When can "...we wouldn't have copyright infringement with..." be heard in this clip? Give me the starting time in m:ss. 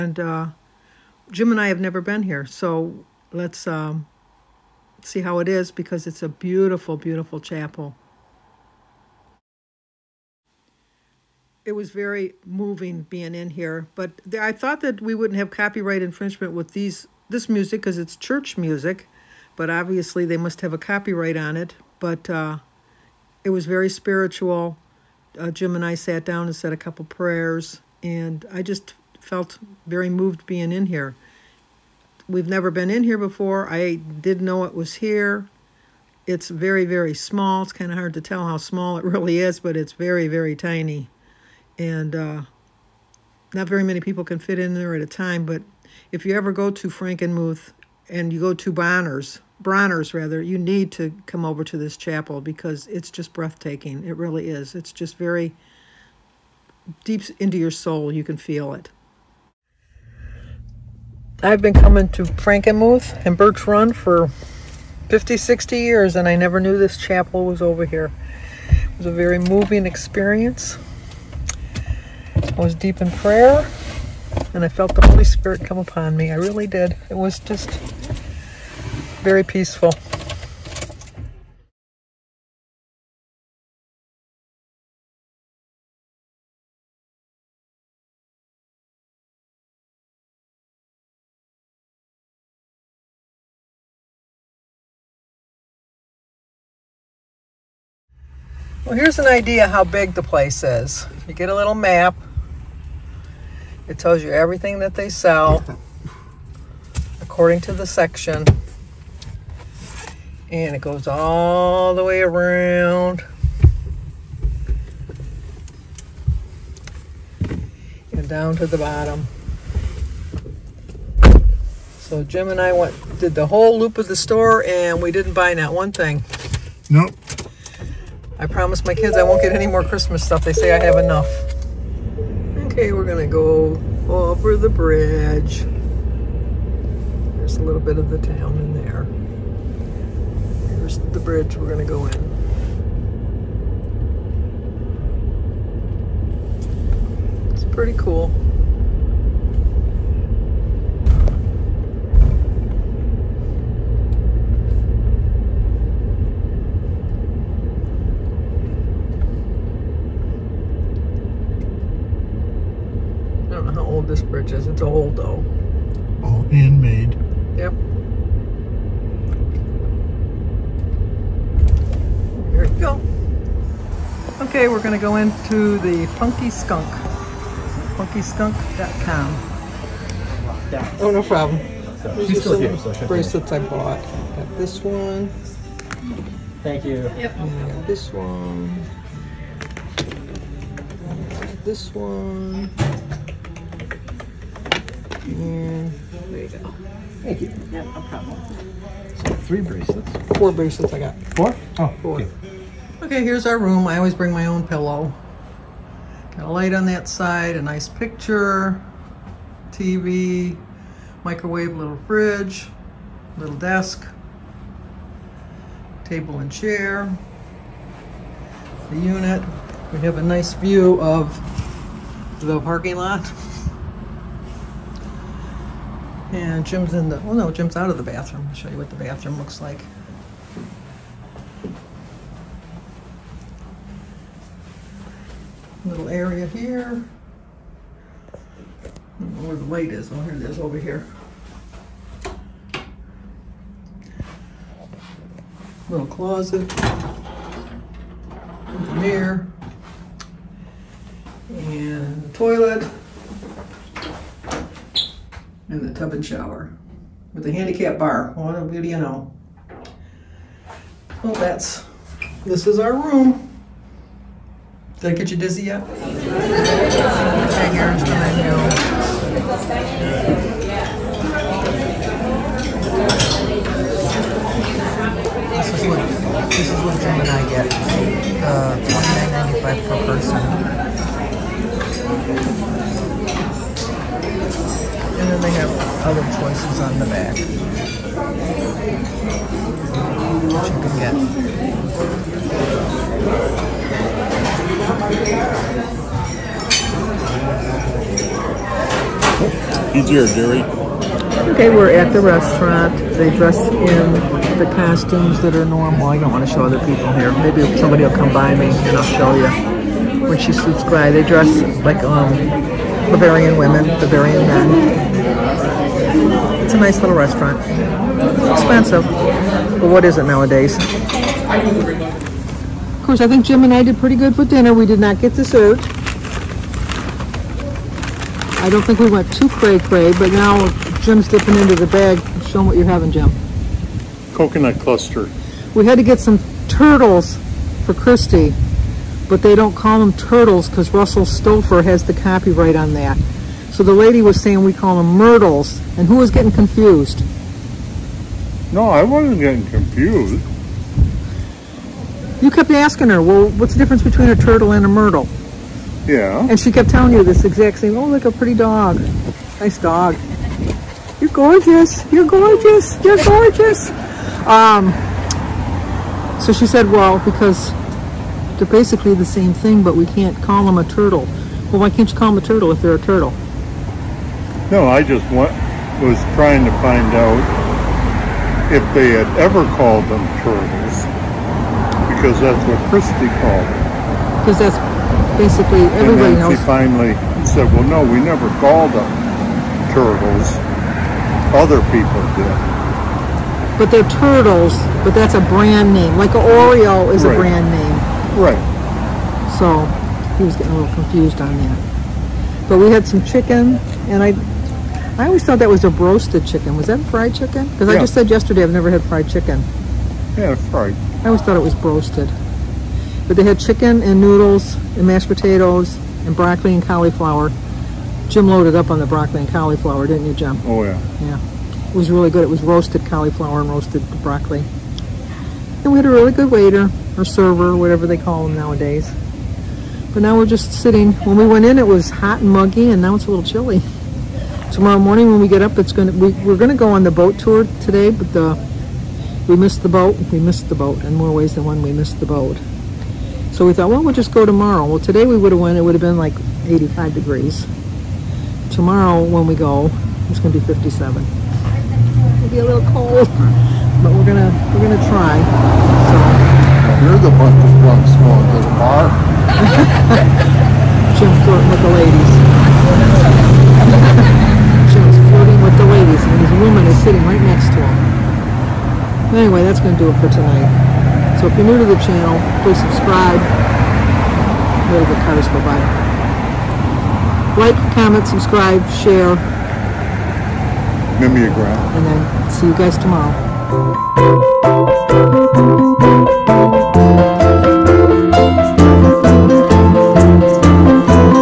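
0:15.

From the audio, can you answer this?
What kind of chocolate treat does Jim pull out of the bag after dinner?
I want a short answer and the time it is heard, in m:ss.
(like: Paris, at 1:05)
Coconut cluster, at 5:34.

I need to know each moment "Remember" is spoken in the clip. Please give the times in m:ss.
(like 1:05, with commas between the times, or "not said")
8:01.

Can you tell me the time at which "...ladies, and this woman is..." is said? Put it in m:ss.
7:45.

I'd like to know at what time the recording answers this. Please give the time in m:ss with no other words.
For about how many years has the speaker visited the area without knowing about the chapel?
1:05.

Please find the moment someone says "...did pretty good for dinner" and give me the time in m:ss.
5:23.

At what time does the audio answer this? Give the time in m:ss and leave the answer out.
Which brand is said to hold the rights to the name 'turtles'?
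5:40.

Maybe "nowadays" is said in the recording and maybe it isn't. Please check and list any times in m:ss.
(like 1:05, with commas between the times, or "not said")
5:20, 7:08.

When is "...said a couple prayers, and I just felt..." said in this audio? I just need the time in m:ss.
0:26.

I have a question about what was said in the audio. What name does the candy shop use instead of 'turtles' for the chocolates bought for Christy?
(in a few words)
Myrtles.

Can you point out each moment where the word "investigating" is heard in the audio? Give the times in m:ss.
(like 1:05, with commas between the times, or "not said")
not said.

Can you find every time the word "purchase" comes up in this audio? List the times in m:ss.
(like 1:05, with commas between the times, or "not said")
2:44.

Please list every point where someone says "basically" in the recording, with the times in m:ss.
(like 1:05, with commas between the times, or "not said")
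6:08, 6:25.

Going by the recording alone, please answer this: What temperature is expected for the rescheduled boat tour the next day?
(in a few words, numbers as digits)
57 degrees.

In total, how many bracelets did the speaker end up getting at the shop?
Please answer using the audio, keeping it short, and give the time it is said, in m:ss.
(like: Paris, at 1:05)
4, at 3:20.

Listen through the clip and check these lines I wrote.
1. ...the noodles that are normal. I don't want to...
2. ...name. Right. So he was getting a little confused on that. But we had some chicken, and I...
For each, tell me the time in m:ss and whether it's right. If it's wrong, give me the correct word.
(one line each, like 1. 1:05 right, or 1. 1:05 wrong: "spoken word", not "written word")
1. 5:04 wrong: "costumes", not "noodles"
2. 6:37 right.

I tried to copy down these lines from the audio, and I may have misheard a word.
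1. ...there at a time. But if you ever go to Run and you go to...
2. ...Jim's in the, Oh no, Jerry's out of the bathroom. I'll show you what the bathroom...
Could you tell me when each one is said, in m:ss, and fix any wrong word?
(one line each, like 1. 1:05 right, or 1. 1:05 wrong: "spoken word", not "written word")
1. 0:44 wrong: "Frankenmuth", not "Run"
2. 3:46 wrong: "Jim", not "Jerry".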